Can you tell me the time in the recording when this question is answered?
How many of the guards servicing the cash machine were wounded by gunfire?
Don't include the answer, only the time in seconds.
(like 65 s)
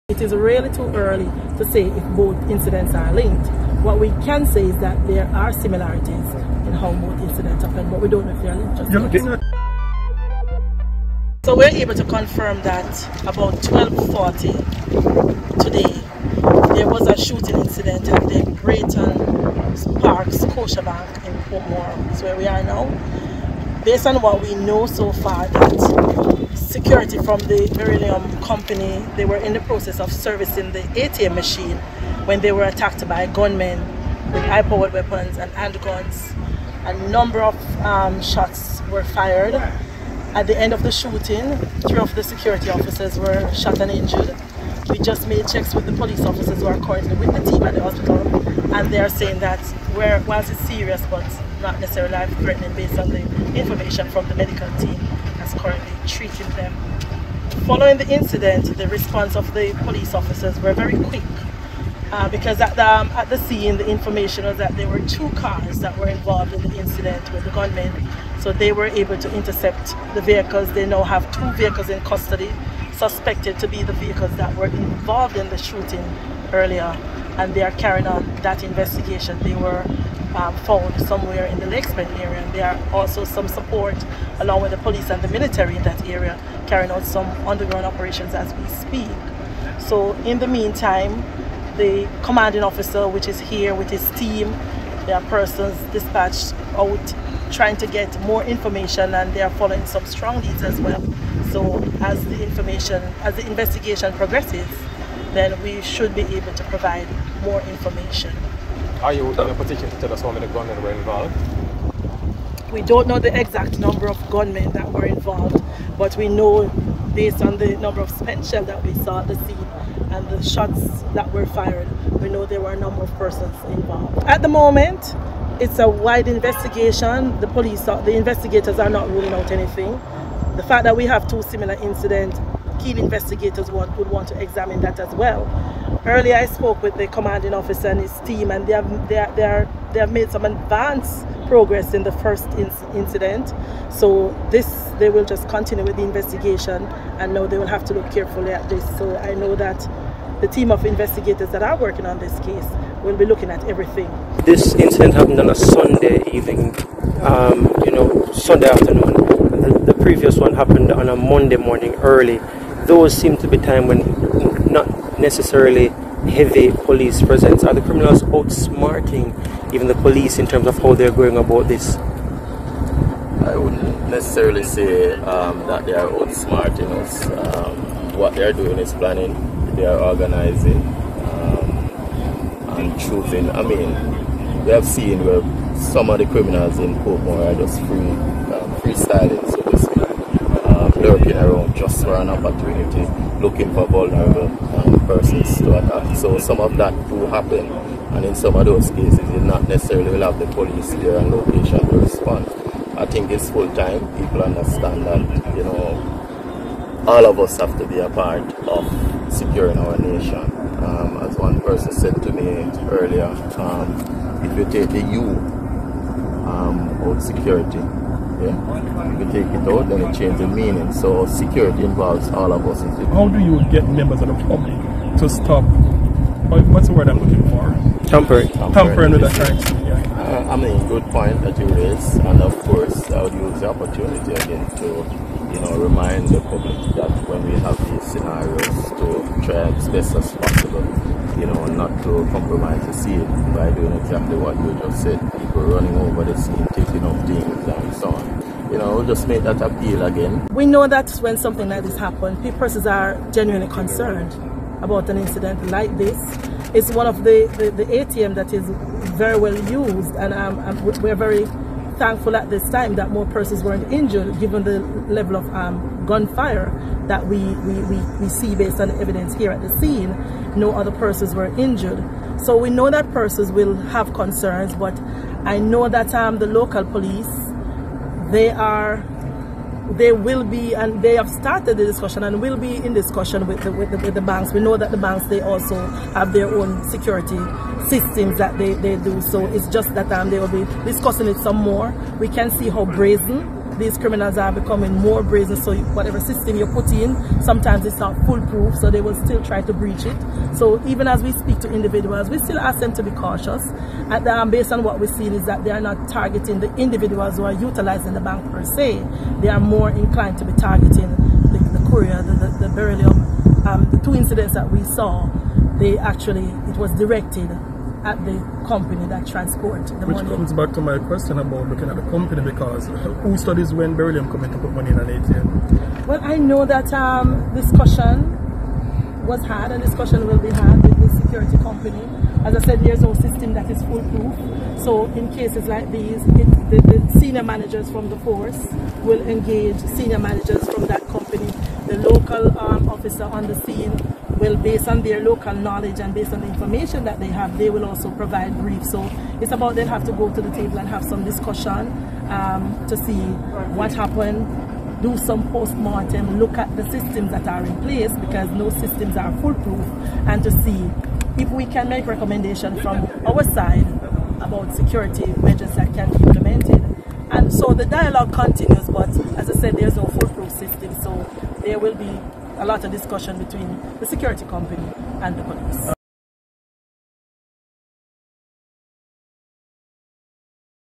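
41 s.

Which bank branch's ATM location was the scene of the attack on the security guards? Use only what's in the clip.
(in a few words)
Braeton Park Scotiabank.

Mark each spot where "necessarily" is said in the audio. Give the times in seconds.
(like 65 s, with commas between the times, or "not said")
51 s, 165 s, 174 s, 199 s.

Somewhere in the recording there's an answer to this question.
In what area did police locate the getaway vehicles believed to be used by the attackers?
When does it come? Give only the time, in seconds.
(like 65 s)
81 s.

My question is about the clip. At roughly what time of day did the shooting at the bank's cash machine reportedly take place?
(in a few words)
12.40.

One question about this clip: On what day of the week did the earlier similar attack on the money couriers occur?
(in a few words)
Monday.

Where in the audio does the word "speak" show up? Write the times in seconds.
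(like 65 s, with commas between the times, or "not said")
88 s, 301 s.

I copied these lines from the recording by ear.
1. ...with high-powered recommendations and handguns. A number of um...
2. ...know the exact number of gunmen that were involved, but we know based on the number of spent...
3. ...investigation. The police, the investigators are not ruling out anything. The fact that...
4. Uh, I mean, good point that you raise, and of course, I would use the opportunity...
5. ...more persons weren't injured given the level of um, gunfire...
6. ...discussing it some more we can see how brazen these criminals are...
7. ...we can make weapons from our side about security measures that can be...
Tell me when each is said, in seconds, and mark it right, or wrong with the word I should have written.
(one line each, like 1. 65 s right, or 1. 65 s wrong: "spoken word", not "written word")
1. 34 s wrong: "weapons", not "recommendations"
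2. 113 s right
3. 126 s right
4. 230 s right
5. 263 s right
6. 290 s right
7. 361 s wrong: "recommendations", not "weapons".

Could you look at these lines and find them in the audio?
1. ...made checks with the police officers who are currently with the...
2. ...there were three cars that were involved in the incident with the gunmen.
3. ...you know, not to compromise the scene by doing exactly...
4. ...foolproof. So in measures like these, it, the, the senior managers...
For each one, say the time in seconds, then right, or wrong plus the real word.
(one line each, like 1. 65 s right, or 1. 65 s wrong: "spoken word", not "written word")
1. 45 s right
2. 64 s wrong: "two", not "three"
3. 241 s right
4. 333 s wrong: "cases", not "measures".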